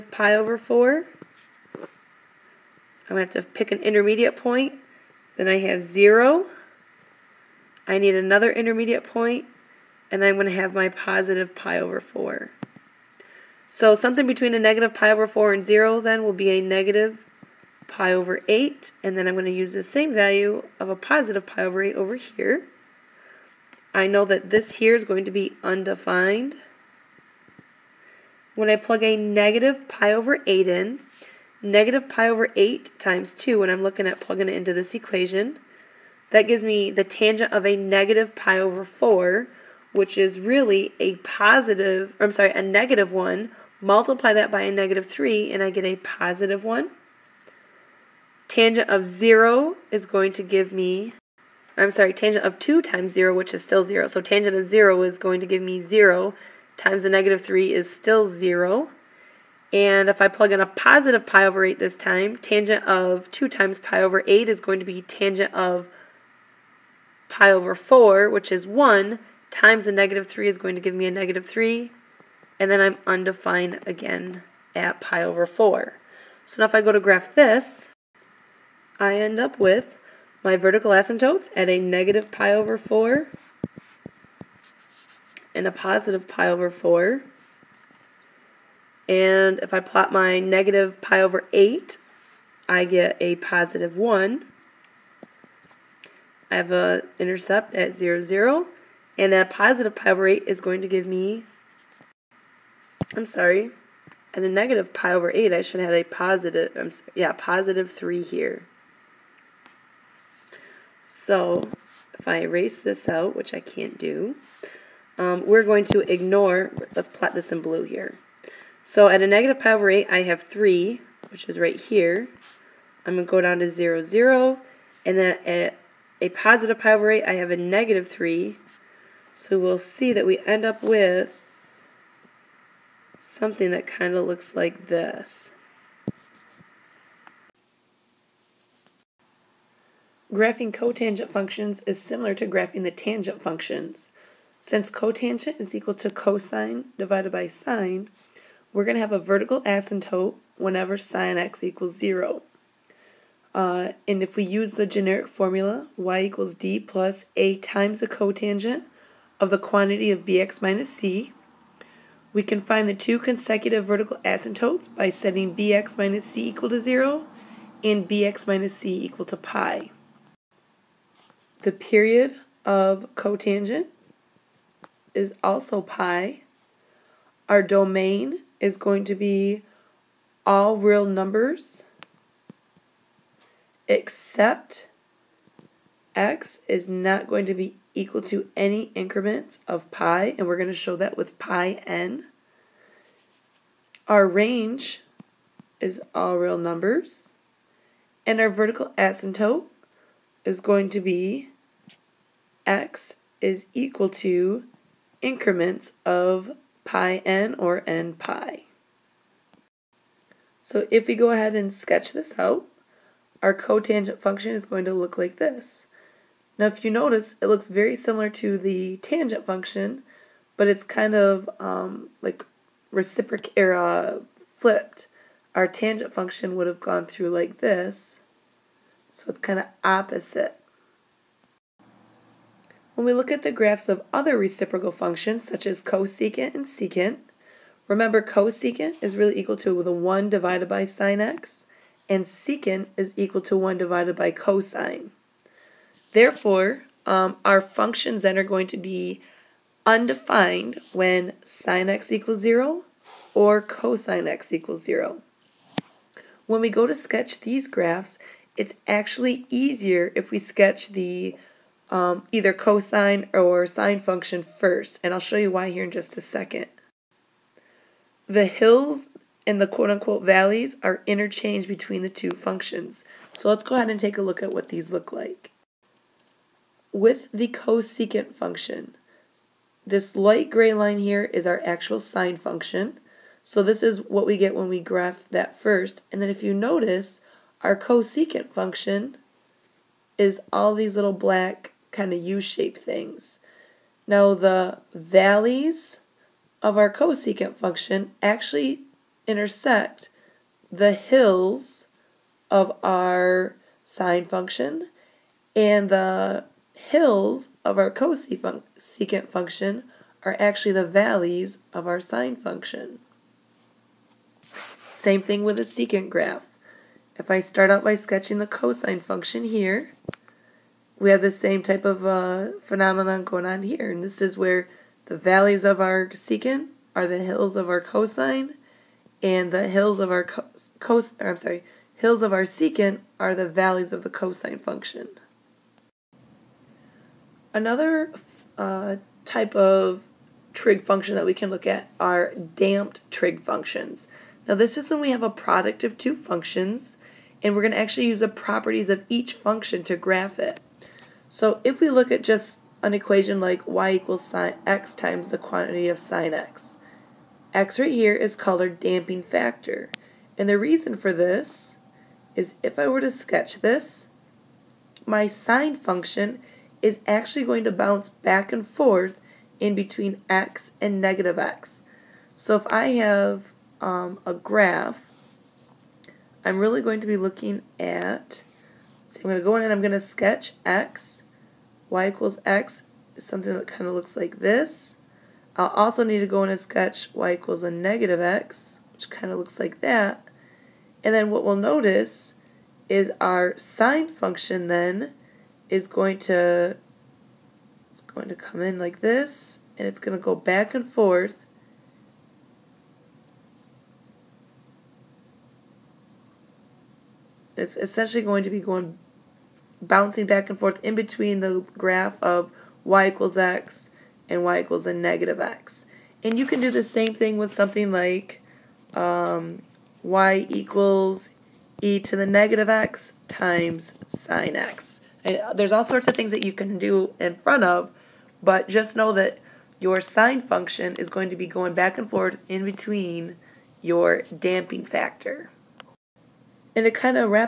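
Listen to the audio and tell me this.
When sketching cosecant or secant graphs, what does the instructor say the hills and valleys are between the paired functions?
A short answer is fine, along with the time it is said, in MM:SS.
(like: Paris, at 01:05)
interchanged, at 04:31.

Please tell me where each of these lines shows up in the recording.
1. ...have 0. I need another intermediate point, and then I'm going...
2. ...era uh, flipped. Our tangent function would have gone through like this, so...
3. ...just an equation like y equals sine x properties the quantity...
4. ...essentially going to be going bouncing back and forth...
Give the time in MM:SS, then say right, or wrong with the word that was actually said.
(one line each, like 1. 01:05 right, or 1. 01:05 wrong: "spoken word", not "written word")
1. 00:05 right
2. 03:43 right
3. 05:52 wrong: "times", not "properties"
4. 06:47 right.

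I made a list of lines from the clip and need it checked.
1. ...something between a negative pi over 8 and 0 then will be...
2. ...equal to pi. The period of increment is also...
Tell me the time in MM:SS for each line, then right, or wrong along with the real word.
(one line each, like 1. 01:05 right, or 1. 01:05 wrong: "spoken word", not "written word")
1. 00:13 wrong: "4", not "8"
2. 02:49 wrong: "cotangent", not "increment".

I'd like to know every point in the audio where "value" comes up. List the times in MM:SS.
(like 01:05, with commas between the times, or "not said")
00:20.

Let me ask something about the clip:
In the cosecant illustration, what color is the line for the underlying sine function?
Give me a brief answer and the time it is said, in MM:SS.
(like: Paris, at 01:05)
light gray, at 04:40.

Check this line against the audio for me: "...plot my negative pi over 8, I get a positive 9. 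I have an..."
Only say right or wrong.
wrong.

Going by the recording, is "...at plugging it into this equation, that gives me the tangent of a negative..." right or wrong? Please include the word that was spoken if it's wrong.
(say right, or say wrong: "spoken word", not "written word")
right.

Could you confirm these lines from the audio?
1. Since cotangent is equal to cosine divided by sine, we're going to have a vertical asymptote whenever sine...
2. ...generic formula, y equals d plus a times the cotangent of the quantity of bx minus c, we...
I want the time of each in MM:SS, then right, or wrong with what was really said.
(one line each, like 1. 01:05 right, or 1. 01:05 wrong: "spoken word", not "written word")
1. 02:24 right
2. 02:34 right.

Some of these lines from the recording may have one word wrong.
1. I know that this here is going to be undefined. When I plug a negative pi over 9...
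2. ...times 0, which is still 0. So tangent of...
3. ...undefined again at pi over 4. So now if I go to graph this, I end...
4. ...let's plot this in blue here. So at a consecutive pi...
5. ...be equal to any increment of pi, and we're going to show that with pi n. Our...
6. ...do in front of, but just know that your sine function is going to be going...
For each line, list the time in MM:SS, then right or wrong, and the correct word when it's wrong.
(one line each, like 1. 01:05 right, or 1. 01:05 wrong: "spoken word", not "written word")
1. 00:23 wrong: "8", not "9"
2. 00:52 right
3. 01:13 right
4. 01:56 wrong: "negative", not "consecutive"
5. 03:07 right
6. 07:06 right.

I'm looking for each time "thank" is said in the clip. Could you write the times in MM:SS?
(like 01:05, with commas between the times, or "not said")
not said.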